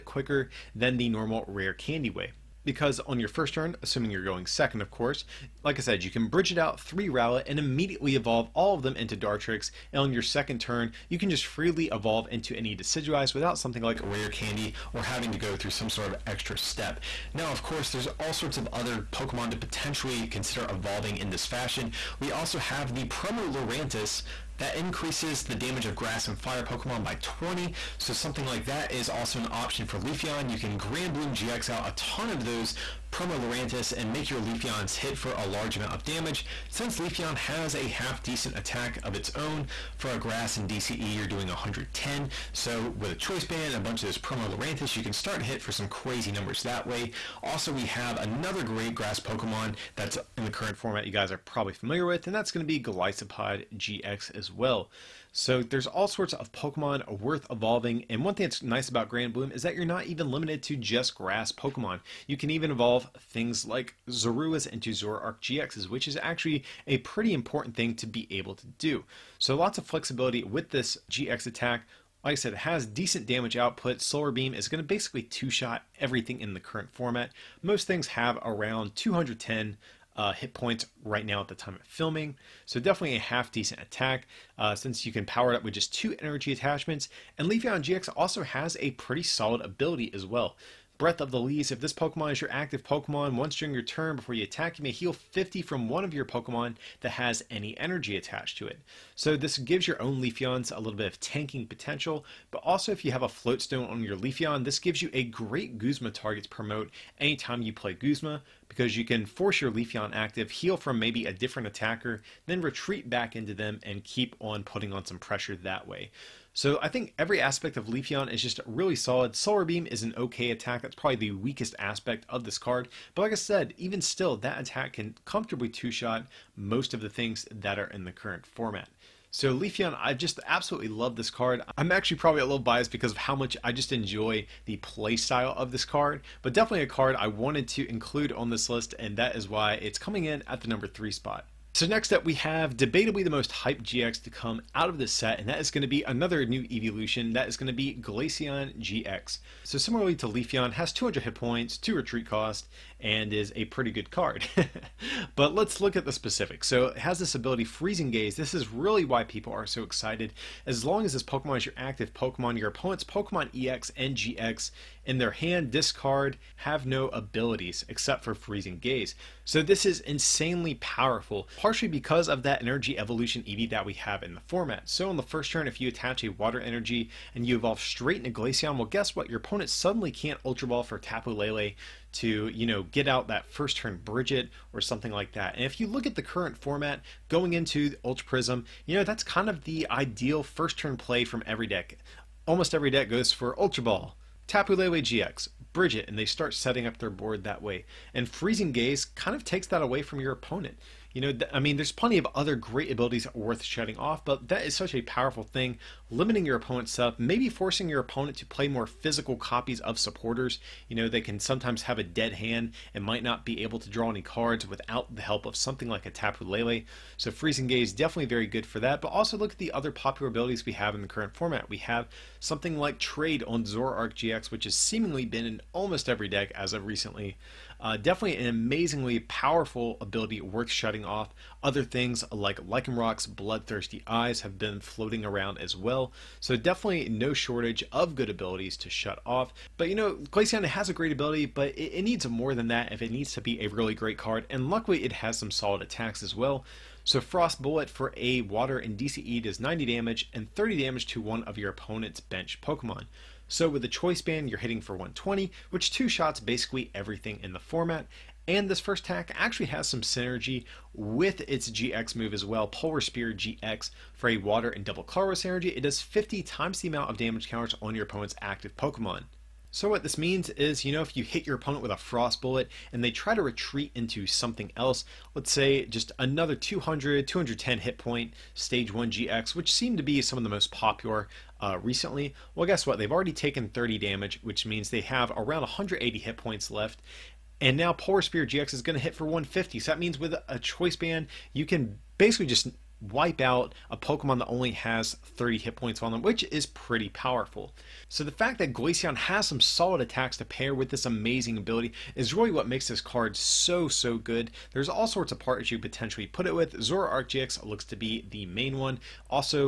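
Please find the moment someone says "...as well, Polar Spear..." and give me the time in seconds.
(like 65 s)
262 s.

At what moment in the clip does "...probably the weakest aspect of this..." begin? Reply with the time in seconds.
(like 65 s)
120 s.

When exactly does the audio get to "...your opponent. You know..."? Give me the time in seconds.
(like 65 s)
200 s.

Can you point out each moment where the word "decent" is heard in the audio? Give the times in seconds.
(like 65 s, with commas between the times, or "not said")
38 s, 72 s, 83 s.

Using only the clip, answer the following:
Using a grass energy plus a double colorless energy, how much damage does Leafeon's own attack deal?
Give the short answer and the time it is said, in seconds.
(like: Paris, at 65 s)
110, at 41 s.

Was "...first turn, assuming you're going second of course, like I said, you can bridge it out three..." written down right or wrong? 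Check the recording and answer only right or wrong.
right.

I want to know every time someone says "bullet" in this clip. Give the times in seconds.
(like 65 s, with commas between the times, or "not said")
247 s, 272 s.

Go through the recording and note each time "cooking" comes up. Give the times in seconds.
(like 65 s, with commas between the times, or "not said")
not said.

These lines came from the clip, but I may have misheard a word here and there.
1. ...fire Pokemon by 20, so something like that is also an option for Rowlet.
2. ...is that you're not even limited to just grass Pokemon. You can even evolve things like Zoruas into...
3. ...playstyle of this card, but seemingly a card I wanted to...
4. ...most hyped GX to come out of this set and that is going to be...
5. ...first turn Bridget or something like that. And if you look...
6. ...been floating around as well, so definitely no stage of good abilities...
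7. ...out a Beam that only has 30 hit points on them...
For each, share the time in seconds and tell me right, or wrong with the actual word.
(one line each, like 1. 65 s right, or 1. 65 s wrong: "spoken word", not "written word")
1. 26 s wrong: "Leafeon", not "Rowlet"
2. 59 s right
3. 134 s wrong: "definitely", not "seemingly"
4. 143 s right
5. 183 s right
6. 234 s wrong: "shortage", not "stage"
7. 293 s wrong: "Pokemon", not "Beam".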